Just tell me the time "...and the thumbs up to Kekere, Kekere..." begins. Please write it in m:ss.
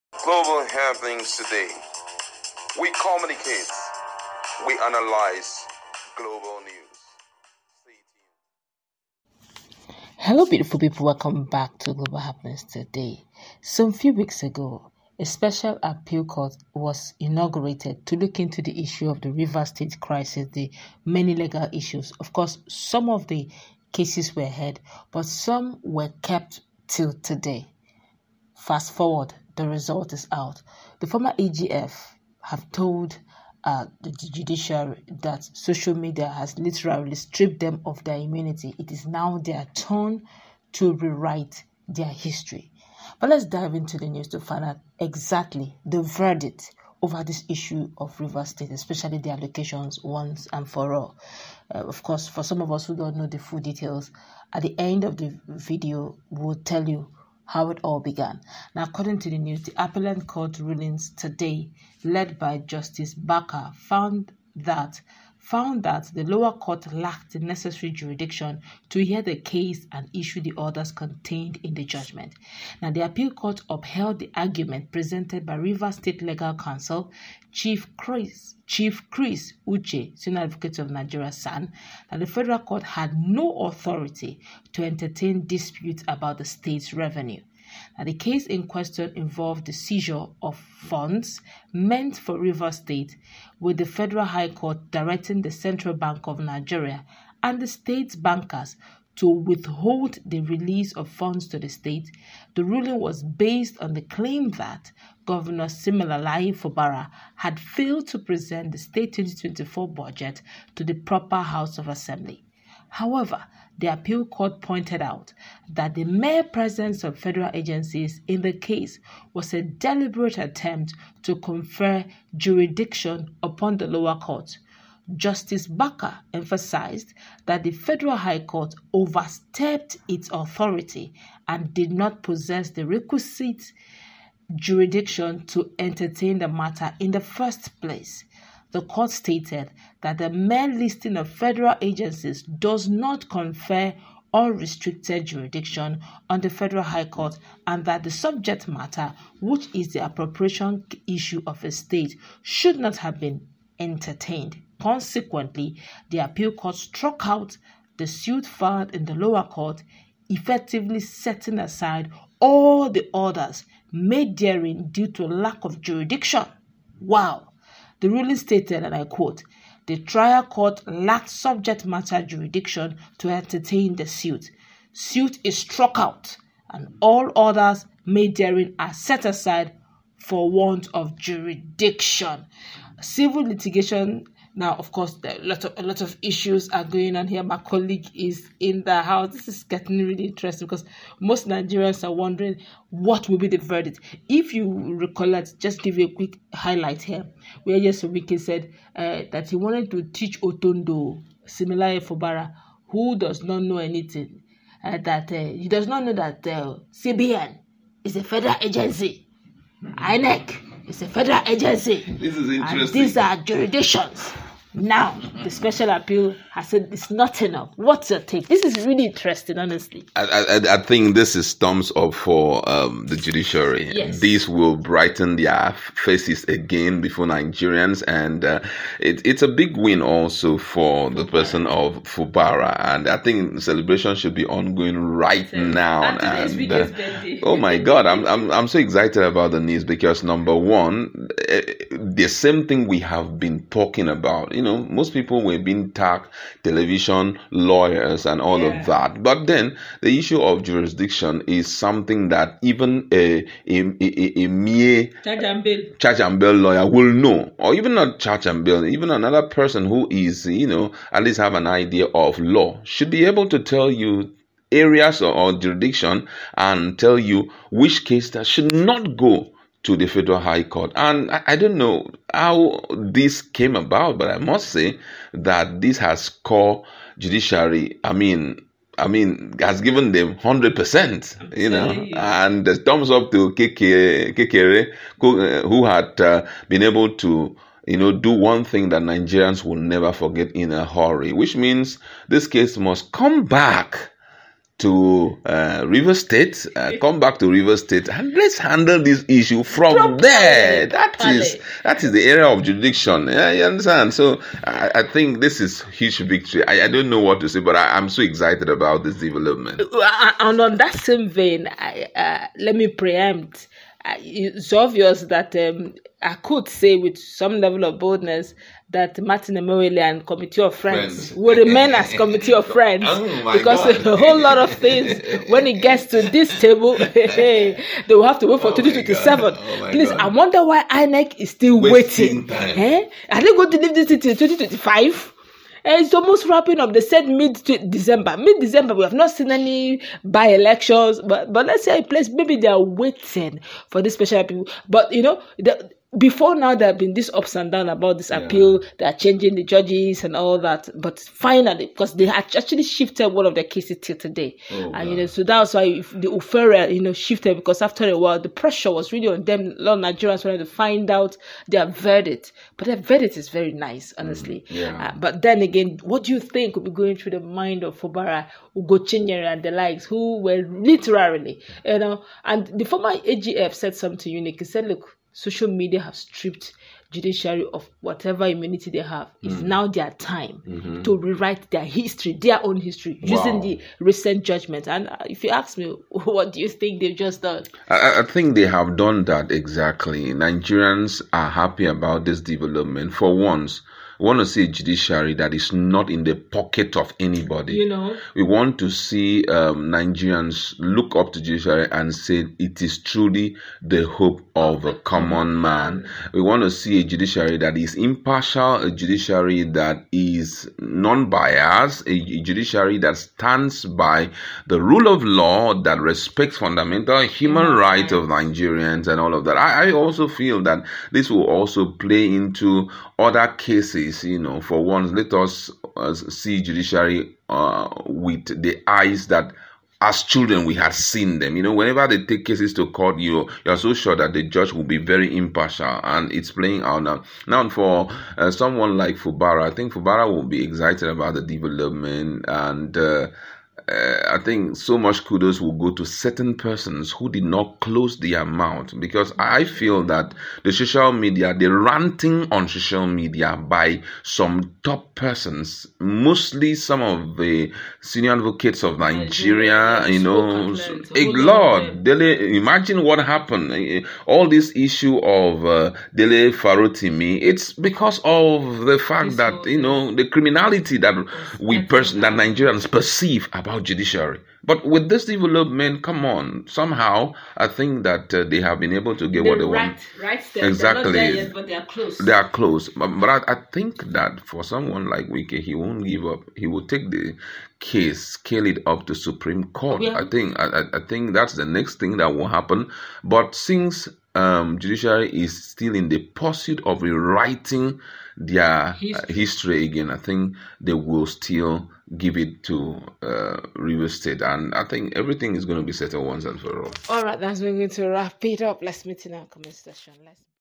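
4:41.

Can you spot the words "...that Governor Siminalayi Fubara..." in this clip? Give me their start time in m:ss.
1:44.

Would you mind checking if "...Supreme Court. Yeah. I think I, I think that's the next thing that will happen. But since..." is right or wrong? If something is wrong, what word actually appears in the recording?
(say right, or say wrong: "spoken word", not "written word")
right.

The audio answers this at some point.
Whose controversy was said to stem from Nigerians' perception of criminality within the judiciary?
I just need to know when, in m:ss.
7:46.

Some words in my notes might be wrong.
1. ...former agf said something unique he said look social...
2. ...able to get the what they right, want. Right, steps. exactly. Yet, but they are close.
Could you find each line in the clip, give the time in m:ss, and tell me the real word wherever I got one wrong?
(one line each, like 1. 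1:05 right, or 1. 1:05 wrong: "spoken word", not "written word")
1. 6:12 right
2. 7:58 right.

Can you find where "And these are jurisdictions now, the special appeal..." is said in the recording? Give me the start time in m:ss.
3:32.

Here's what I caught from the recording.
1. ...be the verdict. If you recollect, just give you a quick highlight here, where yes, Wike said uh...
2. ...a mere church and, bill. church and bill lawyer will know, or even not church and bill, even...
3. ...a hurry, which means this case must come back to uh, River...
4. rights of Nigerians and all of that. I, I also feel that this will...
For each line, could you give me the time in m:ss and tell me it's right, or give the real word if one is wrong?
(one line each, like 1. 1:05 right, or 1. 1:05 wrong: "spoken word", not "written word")
1. 3:13 right
2. 4:14 right
3. 4:50 right
4. 6:57 right.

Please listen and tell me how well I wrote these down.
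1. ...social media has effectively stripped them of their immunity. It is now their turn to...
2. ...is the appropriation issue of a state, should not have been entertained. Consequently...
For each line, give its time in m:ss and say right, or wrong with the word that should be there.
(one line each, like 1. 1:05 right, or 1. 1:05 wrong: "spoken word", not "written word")
1. 0:35 wrong: "literally", not "effectively"
2. 2:29 right.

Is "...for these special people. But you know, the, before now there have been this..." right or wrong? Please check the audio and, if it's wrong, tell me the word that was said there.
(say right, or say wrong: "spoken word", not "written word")
right.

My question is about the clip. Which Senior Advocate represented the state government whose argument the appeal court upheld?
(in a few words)
Chris Uche.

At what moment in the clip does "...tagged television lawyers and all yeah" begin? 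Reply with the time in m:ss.
4:05.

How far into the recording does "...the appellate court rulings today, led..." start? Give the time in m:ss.
0:59.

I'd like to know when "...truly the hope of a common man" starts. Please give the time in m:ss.
6:43.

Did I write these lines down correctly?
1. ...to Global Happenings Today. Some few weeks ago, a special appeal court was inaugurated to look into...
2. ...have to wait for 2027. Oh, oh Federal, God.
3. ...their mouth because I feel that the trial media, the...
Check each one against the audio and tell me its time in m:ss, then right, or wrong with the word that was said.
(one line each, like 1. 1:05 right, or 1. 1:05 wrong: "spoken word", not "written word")
1. 0:11 right
2. 5:28 wrong: "Please", not "Federal"
3. 7:28 wrong: "social", not "trial".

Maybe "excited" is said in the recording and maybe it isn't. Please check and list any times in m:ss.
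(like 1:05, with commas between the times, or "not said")
3:58, 5:08, 7:20.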